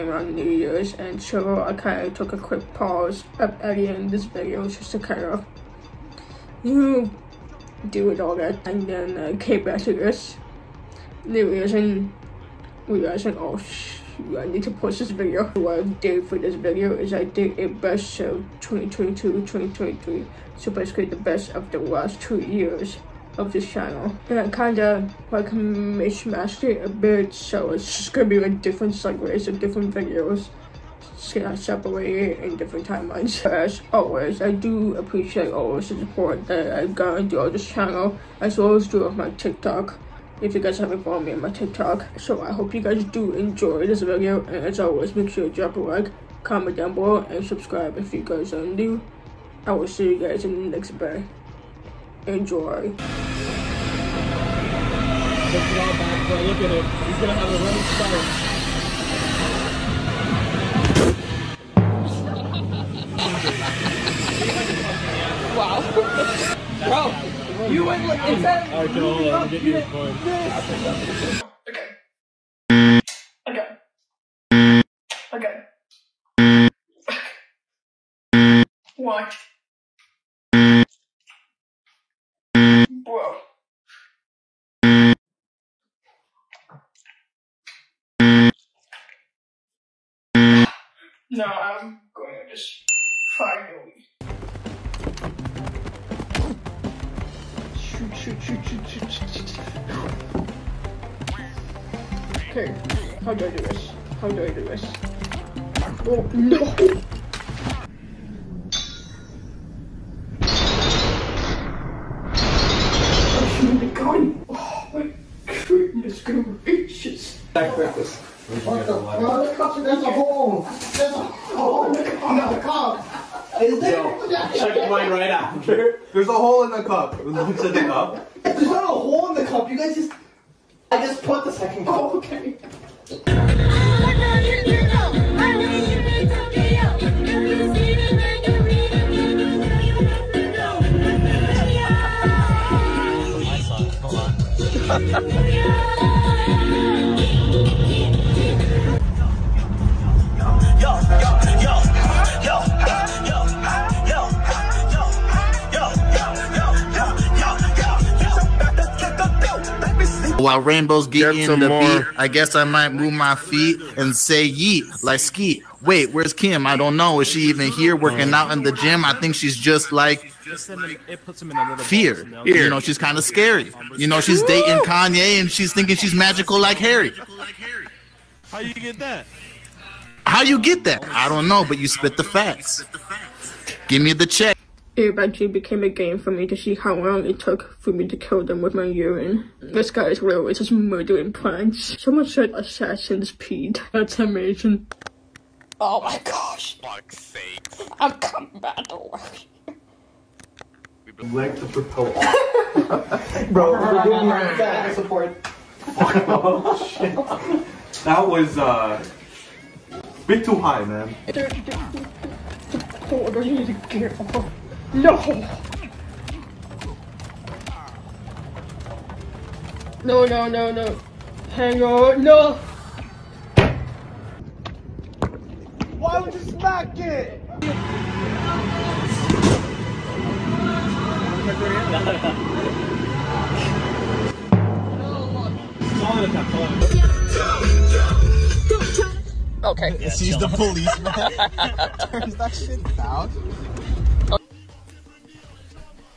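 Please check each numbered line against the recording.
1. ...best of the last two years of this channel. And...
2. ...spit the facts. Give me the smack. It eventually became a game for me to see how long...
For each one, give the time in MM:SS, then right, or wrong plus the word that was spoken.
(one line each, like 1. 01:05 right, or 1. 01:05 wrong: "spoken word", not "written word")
1. 00:21 right
2. 03:01 wrong: "check", not "smack".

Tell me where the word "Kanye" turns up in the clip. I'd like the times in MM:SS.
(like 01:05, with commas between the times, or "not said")
02:54.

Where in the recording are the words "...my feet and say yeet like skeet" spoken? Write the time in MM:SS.
02:43.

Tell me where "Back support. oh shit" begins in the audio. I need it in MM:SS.
03:24.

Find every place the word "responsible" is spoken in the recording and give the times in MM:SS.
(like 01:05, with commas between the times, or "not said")
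not said.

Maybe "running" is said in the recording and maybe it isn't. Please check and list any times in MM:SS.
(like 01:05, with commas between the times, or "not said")
00:57.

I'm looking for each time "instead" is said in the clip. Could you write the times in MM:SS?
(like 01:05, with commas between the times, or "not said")
01:08.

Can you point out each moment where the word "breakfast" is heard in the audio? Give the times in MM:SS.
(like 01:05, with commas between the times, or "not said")
01:57.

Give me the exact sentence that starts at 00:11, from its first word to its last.
And then we realizing, oh I need to post this video.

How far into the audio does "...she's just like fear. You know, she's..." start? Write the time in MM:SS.
02:49.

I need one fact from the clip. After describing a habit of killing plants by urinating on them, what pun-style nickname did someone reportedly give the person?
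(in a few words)
Assassin's peed.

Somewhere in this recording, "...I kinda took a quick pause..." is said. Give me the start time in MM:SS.
00:01.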